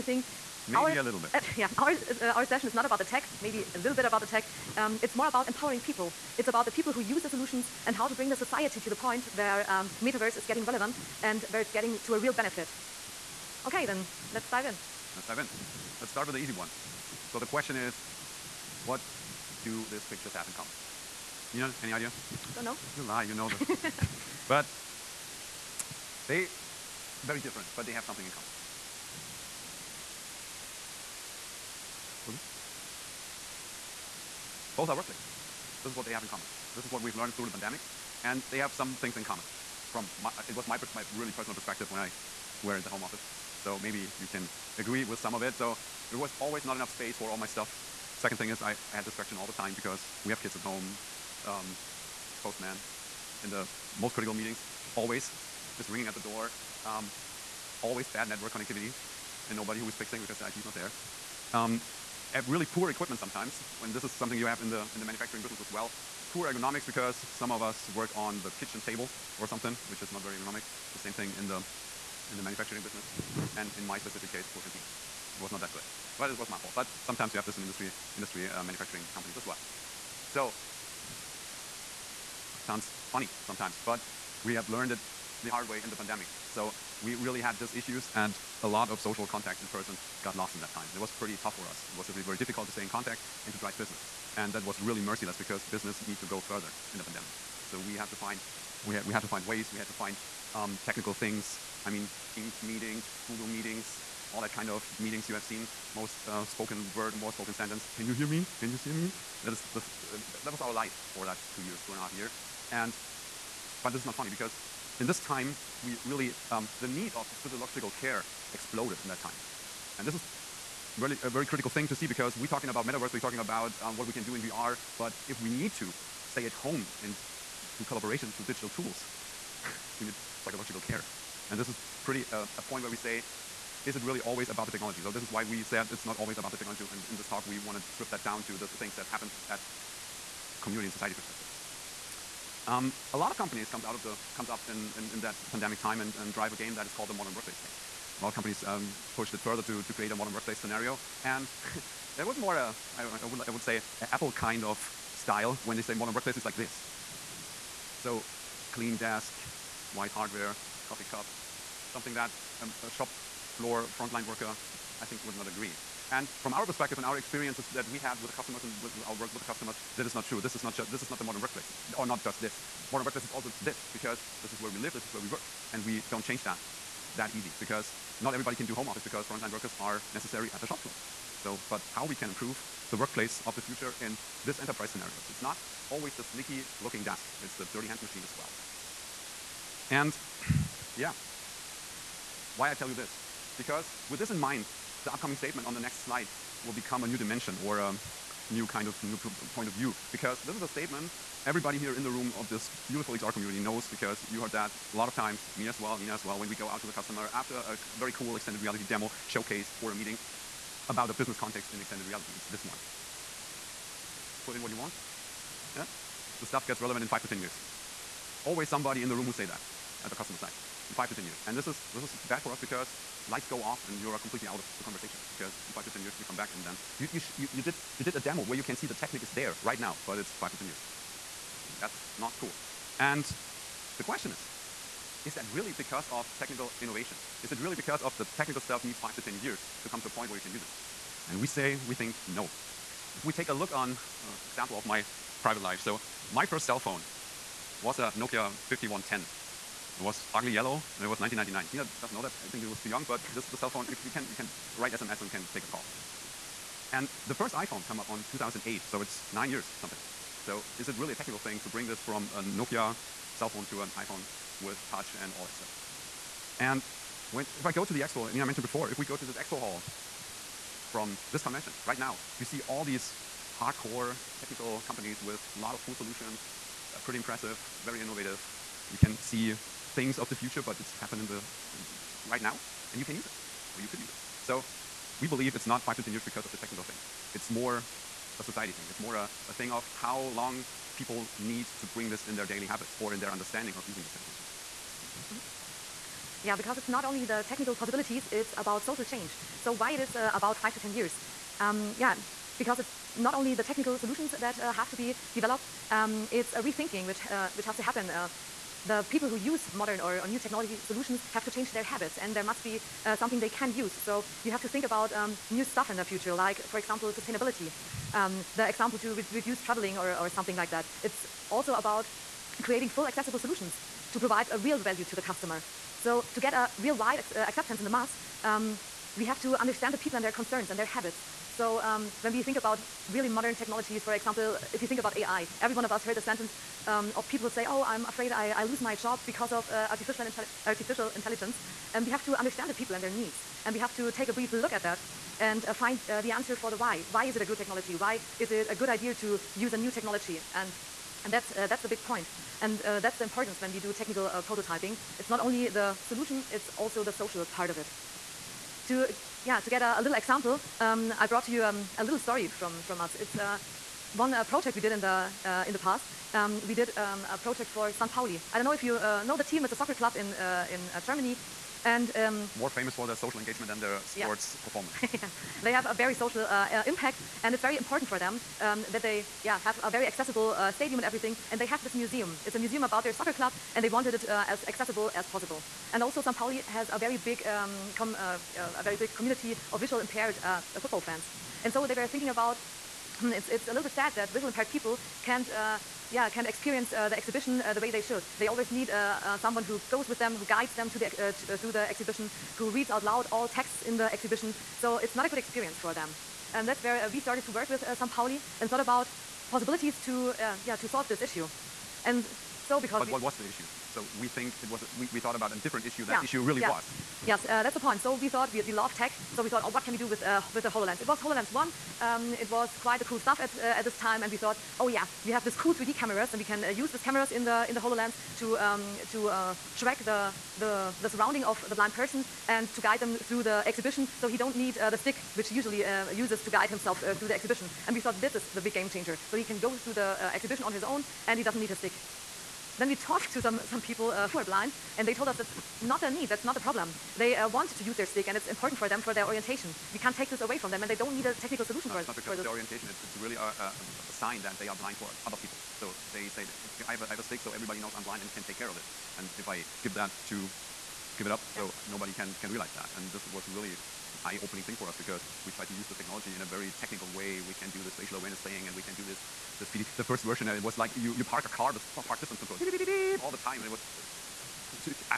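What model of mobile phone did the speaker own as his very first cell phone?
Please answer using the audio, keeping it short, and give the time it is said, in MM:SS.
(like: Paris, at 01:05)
Nokia 5110, at 04:08.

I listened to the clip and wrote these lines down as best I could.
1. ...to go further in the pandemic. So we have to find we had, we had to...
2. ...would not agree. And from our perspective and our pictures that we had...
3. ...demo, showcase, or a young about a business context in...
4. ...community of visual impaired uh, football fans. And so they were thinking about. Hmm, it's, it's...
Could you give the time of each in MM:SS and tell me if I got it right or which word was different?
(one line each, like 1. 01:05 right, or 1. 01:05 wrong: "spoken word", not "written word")
1. 01:36 right
2. 02:45 wrong: "experiences", not "pictures"
3. 03:28 wrong: "meeting", not "young"
4. 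06:29 right.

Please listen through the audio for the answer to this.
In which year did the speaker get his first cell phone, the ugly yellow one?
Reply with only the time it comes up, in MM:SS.
04:11.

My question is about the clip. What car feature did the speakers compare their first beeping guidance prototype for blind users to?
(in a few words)
park distance control.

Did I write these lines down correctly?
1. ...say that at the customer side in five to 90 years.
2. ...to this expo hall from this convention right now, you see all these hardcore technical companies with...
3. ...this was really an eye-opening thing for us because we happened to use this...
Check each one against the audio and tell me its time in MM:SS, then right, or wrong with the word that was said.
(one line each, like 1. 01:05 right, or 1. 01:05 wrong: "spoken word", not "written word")
1. 03:39 wrong: "10", not "90"
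2. 04:29 right
3. 07:43 wrong: "tried", not "happened".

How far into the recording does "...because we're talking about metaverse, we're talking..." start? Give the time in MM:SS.
02:02.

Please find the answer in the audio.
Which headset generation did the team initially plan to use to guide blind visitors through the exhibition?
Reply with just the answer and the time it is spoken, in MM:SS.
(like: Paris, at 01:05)
HoloLens 1, at 07:01.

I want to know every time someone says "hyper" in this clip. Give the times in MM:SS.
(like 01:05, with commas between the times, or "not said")
not said.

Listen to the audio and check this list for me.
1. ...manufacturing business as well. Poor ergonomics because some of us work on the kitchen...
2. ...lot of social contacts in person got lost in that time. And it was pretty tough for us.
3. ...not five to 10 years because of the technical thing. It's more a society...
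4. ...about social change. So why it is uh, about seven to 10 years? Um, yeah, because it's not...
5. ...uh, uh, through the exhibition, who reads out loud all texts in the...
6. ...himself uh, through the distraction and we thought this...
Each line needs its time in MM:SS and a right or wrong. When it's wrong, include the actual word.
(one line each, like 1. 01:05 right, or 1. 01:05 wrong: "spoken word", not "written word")
1. 01:05 right
2. 01:28 right
3. 04:45 right
4. 04:58 wrong: "five", not "seven"
5. 06:41 right
6. 07:16 wrong: "exhibition", not "distraction".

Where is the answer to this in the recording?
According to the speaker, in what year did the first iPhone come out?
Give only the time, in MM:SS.
04:18.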